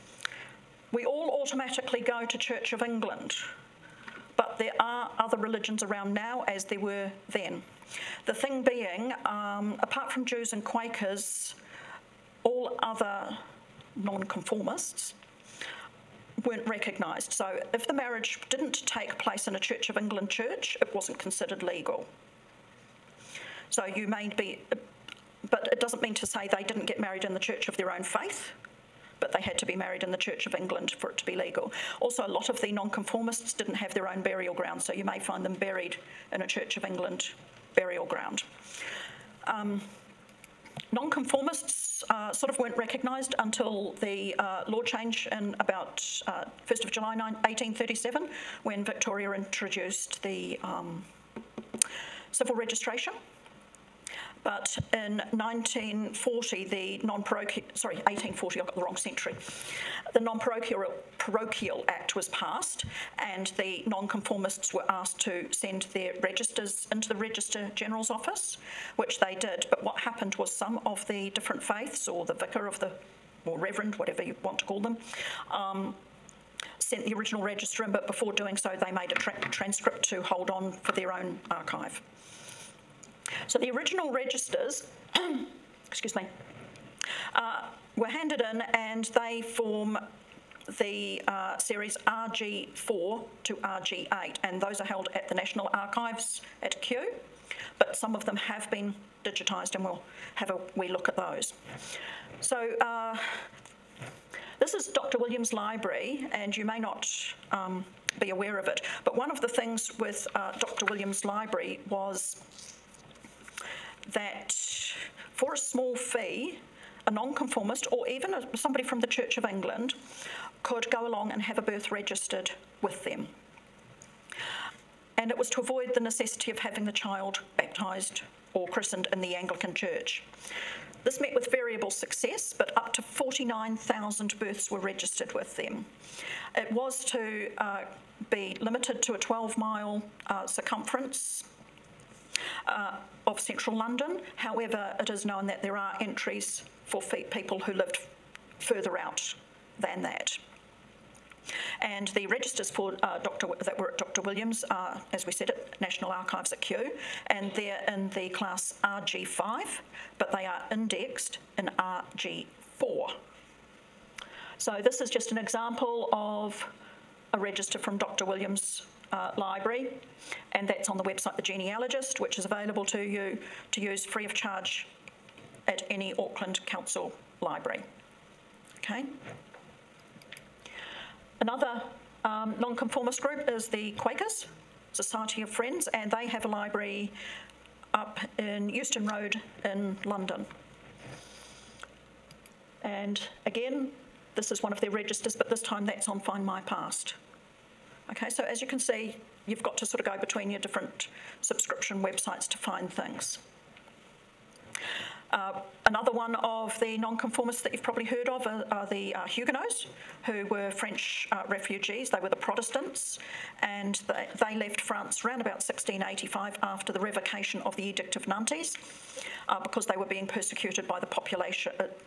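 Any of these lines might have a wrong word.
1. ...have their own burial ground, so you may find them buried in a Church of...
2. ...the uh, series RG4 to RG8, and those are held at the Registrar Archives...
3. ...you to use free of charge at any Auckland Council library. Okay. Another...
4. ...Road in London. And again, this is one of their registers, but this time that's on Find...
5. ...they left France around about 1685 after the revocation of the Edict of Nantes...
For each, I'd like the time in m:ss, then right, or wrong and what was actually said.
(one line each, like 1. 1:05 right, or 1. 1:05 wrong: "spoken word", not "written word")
1. 0:33 right
2. 1:30 wrong: "National", not "Registrar"
3. 2:53 right
4. 3:09 right
5. 3:34 right.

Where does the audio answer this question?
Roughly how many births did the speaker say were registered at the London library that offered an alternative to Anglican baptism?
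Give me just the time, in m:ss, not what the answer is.
2:13.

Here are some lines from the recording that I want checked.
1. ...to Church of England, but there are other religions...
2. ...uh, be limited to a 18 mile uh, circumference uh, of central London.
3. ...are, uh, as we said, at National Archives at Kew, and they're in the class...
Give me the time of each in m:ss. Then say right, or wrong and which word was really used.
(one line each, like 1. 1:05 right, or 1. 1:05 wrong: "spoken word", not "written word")
1. 0:02 right
2. 2:17 wrong: "12", not "18"
3. 2:34 right.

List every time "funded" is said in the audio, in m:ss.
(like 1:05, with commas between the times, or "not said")
not said.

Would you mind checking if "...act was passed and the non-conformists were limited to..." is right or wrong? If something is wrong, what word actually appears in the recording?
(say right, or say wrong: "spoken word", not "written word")
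wrong: "asked", not "limited".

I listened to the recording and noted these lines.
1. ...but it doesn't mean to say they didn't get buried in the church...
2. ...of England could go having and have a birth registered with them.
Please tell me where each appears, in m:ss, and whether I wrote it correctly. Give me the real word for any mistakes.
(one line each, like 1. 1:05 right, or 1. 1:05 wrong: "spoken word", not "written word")
1. 0:25 wrong: "married", not "buried"
2. 1:59 wrong: "along", not "having".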